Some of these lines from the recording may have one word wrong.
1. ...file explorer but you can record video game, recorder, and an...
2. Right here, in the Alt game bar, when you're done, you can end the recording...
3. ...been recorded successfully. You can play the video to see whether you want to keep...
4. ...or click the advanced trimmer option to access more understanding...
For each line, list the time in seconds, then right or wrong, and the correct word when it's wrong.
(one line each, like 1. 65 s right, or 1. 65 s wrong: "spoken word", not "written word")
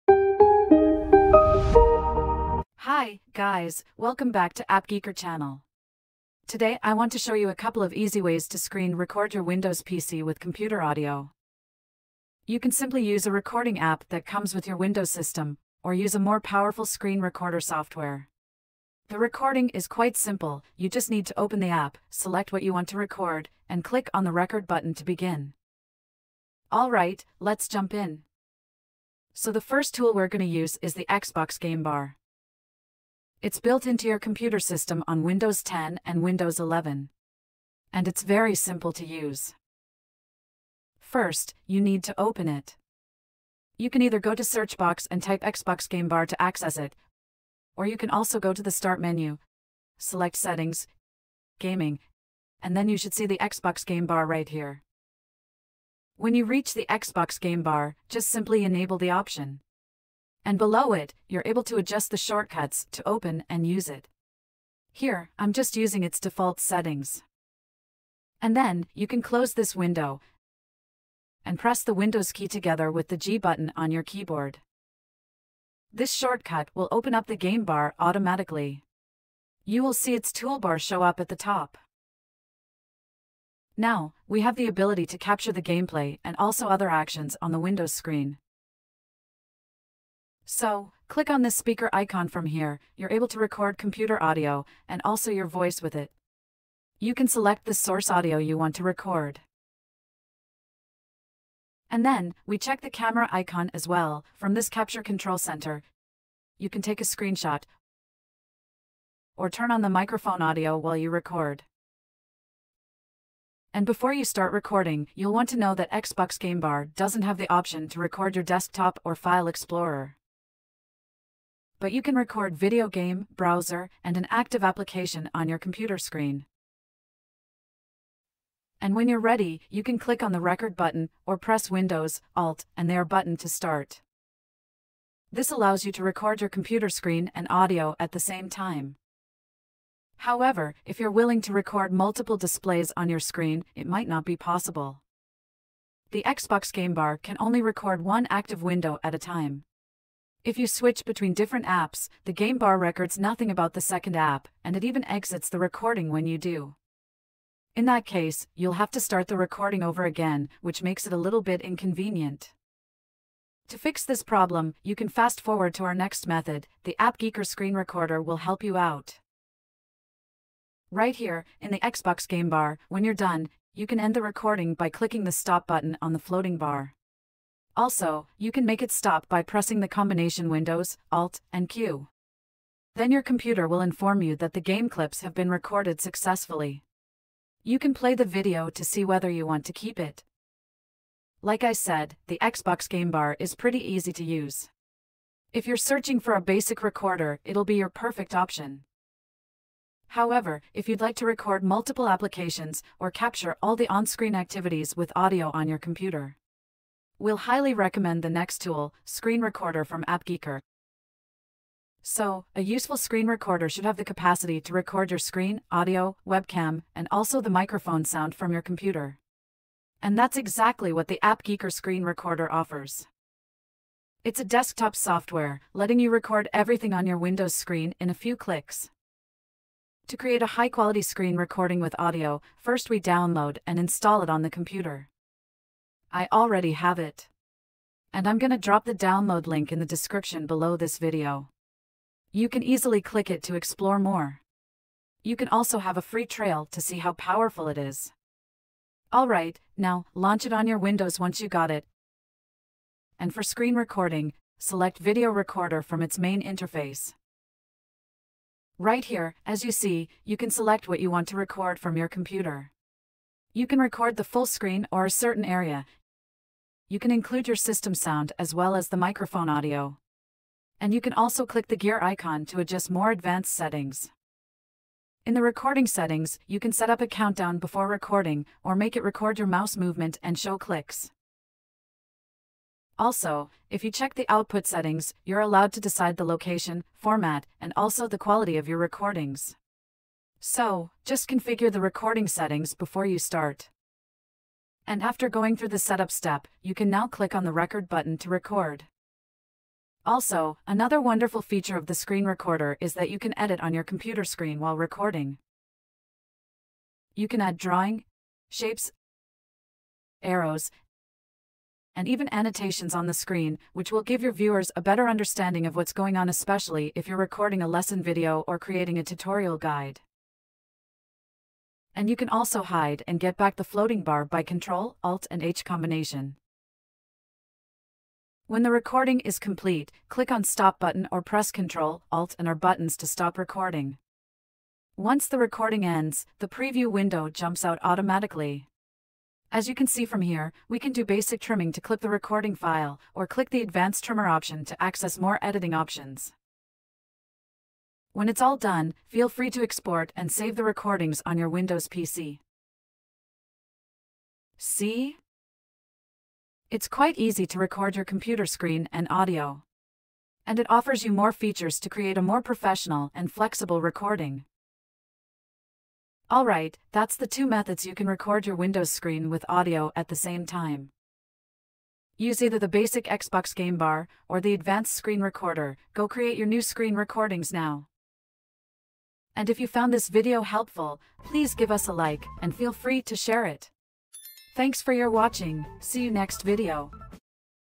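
1. 119 s wrong: "browser", not "recorder"
2. 170 s wrong: "Xbox", not "Alt"
3. 185 s right
4. 343 s wrong: "editing", not "understanding".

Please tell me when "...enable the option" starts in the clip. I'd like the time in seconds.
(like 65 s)
58 s.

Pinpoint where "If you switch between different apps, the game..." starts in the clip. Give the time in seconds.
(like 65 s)
150 s.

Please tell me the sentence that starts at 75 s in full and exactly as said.
This shortcut will open up the game bar automatically.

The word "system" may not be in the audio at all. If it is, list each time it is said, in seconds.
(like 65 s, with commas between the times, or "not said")
15 s, 34 s, 267 s.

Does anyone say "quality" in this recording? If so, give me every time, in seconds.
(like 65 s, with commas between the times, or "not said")
230 s, 288 s.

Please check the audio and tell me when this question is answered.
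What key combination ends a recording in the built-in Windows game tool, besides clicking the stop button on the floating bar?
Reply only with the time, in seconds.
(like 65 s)
180 s.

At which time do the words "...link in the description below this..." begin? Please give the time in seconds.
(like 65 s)
239 s.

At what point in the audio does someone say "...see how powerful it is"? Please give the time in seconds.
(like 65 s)
246 s.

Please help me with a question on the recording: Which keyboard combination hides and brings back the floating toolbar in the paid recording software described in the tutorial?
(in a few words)
Control, Alt and H.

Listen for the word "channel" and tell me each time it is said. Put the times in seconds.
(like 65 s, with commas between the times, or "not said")
5 s.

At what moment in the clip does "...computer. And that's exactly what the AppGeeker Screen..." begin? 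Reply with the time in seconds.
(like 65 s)
218 s.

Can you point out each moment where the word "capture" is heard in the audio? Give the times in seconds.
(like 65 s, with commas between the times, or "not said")
85 s, 104 s, 203 s.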